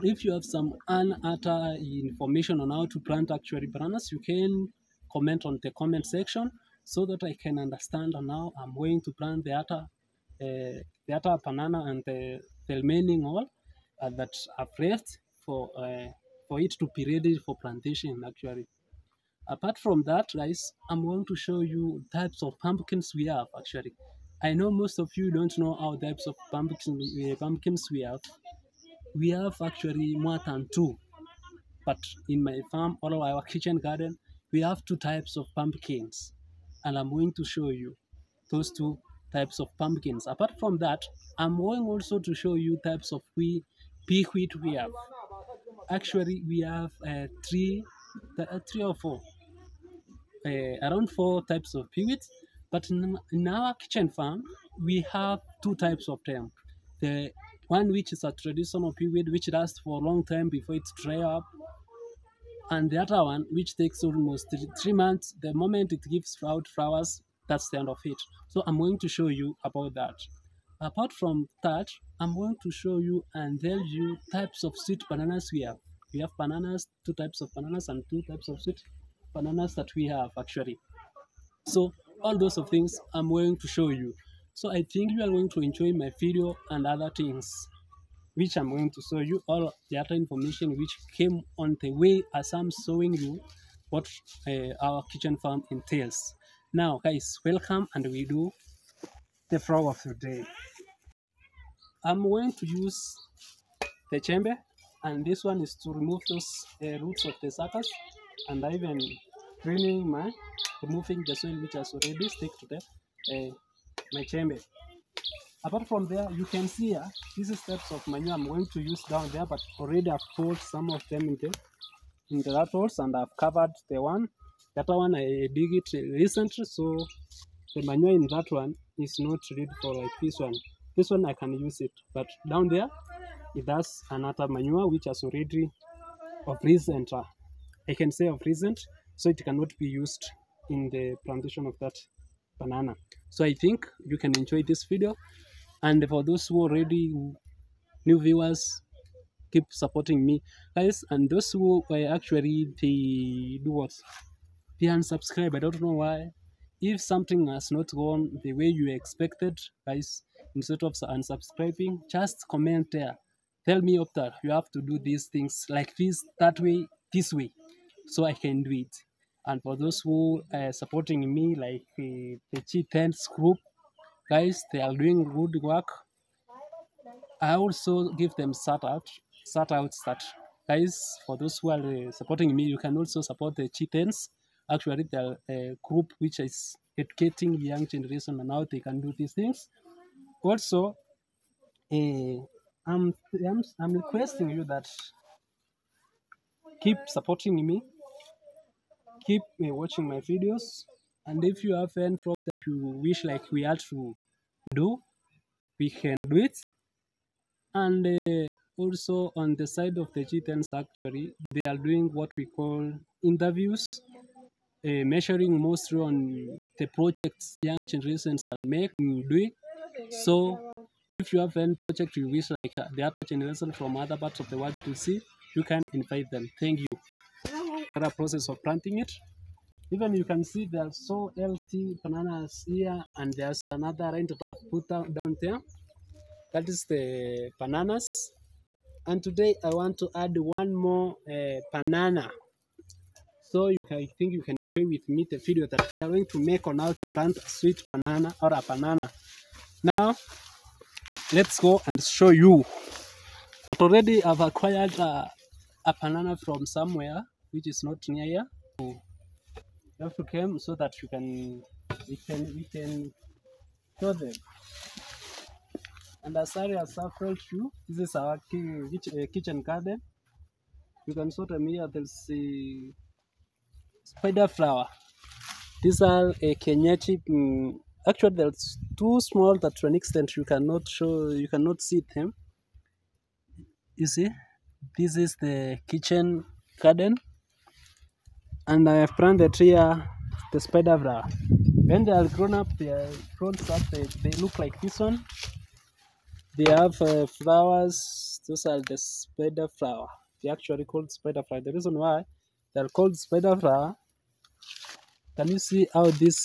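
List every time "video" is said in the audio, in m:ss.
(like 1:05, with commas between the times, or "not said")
1:26, 2:24, 3:20, 4:05.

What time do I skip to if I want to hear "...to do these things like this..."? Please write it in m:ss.
2:44.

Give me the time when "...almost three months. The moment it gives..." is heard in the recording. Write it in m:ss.
1:04.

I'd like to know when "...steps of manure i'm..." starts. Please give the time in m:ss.
1:57.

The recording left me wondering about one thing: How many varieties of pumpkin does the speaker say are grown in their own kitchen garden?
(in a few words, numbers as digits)
2.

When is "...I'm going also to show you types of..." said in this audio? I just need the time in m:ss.
0:41.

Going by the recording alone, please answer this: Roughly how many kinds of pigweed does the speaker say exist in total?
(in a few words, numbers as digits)
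4.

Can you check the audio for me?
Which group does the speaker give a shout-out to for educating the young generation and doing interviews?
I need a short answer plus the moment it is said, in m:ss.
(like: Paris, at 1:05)
G10, at 2:52.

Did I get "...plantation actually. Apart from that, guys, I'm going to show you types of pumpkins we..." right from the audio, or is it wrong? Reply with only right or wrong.
right.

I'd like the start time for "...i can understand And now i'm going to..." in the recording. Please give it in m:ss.
0:07.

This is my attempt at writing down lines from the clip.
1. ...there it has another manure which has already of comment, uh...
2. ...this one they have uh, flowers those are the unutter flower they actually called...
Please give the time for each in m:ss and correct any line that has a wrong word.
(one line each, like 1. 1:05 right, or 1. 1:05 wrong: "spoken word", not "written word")
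1. 2:12 wrong: "recent", not "comment"
2. 4:54 wrong: "spider", not "unutter".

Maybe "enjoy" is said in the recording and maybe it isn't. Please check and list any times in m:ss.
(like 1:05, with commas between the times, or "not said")
1:25, 2:24, 4:04.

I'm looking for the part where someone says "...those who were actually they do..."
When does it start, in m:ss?
2:31.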